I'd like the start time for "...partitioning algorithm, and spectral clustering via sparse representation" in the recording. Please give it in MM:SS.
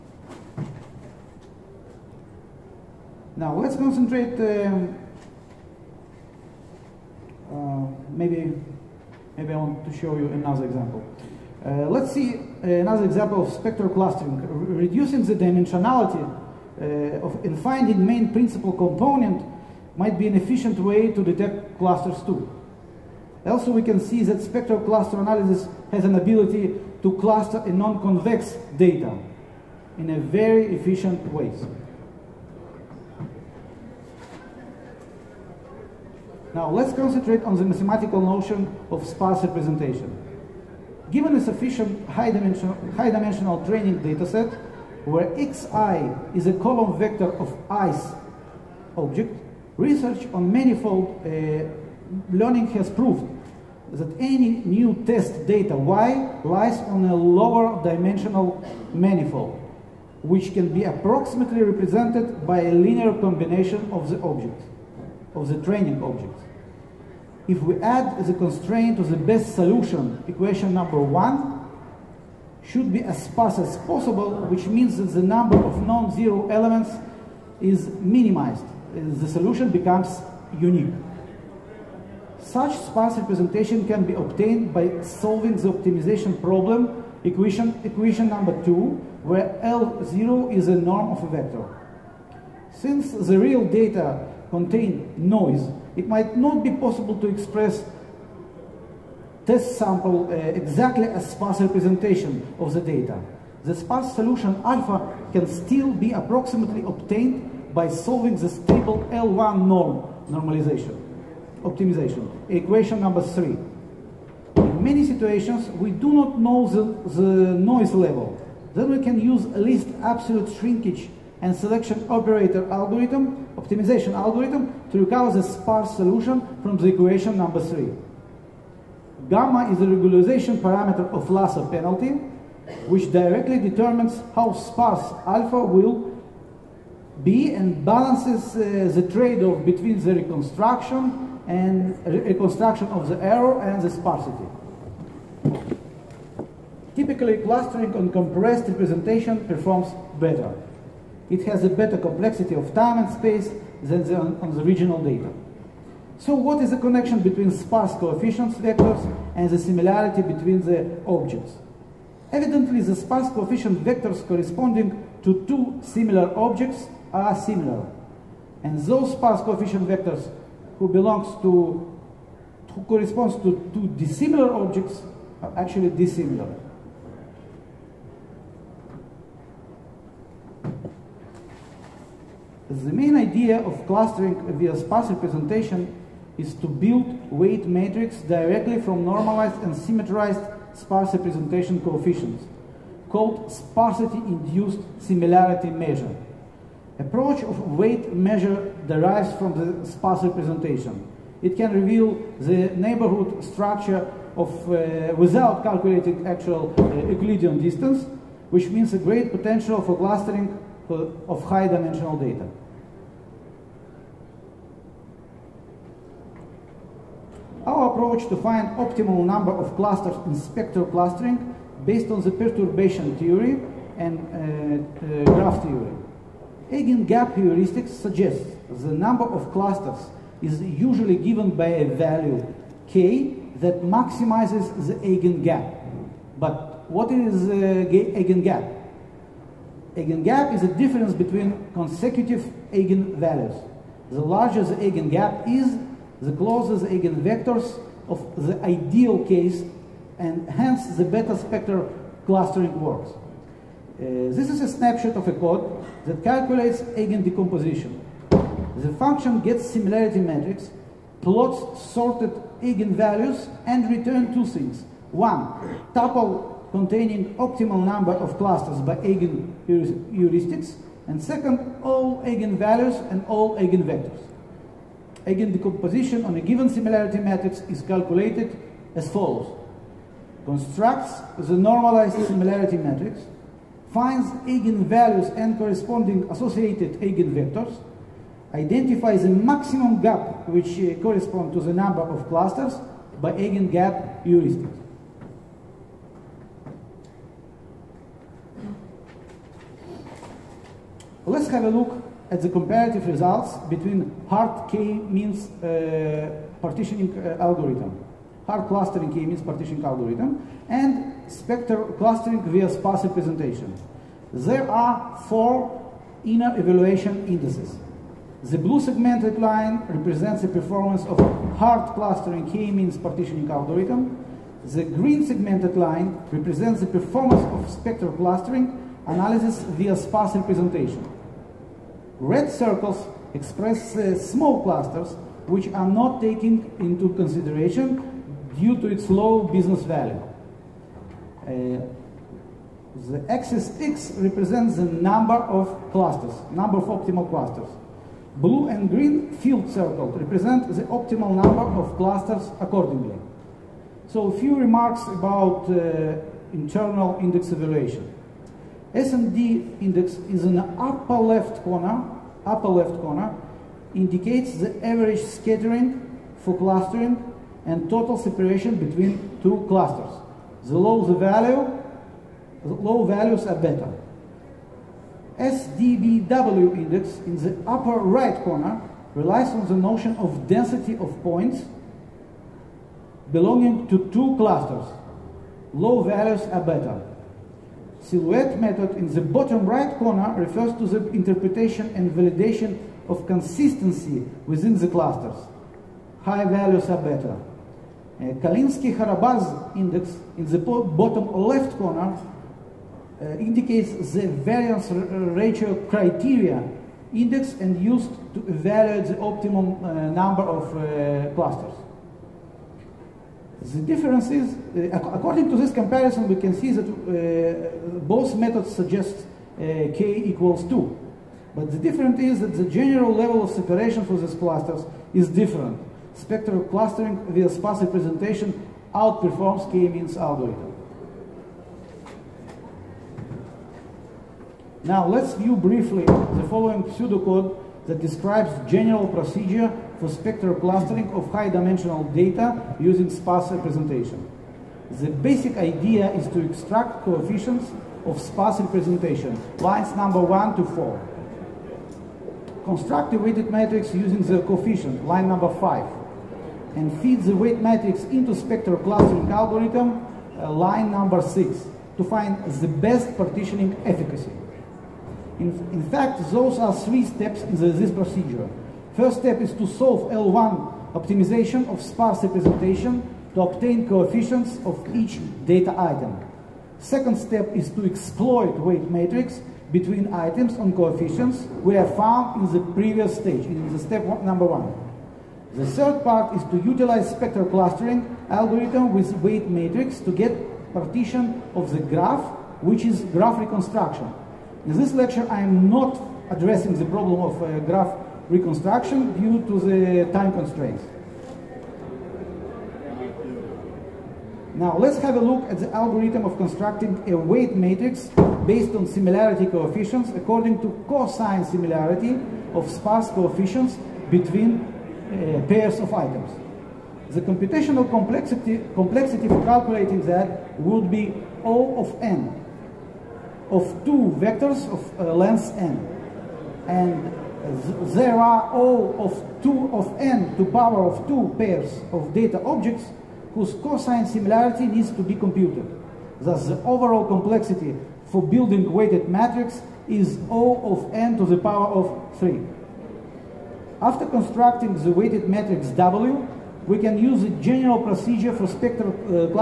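05:09.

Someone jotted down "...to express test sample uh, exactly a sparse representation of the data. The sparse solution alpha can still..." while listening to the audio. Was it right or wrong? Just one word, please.
right.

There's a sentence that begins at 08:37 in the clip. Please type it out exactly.
The computational complexity, complexity for calculating that would be O of n of two vectors of uh, length n.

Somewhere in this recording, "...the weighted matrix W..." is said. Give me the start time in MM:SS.
09:04.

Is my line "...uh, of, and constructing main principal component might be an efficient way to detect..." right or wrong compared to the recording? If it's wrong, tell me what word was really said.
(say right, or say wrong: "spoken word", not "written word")
wrong: "finding", not "constructing".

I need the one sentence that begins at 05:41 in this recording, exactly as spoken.
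Uh, the axis X represents the number of clusters, number of optimal clusters.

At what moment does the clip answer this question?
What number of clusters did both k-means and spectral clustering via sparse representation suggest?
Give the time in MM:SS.
06:59.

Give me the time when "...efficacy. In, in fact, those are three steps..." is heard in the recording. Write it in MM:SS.
07:43.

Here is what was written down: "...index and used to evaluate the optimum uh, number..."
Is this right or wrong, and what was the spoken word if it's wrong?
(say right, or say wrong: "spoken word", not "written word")
right.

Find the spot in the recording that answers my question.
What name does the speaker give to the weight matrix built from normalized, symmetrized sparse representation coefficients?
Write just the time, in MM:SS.
03:13.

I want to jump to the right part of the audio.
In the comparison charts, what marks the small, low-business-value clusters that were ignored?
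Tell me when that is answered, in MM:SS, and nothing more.
05:32.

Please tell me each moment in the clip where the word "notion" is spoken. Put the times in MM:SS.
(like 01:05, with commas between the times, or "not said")
00:38, 06:19.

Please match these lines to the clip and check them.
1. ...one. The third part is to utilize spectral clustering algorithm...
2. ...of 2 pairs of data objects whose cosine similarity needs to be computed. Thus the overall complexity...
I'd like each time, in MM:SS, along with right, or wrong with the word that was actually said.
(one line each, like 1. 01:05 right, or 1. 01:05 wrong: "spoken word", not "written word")
1. 08:04 right
2. 08:50 right.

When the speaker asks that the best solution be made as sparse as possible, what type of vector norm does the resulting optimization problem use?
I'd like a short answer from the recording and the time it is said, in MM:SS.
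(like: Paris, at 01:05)
L0, at 01:29.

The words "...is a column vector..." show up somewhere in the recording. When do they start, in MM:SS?
00:46.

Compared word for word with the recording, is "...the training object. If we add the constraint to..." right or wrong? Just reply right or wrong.
right.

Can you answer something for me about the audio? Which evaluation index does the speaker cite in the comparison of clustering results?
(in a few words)
Calinski-Harabasz index.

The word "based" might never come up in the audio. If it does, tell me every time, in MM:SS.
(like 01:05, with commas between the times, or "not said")
03:41, 08:28.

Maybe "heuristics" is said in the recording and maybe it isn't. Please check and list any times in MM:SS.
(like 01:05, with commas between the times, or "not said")
03:47, 04:29, 04:54.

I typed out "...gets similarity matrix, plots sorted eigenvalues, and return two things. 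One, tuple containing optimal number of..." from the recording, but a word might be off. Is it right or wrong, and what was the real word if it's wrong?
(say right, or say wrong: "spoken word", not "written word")
right.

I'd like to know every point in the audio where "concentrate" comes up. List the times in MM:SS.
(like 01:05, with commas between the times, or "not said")
00:03, 00:36.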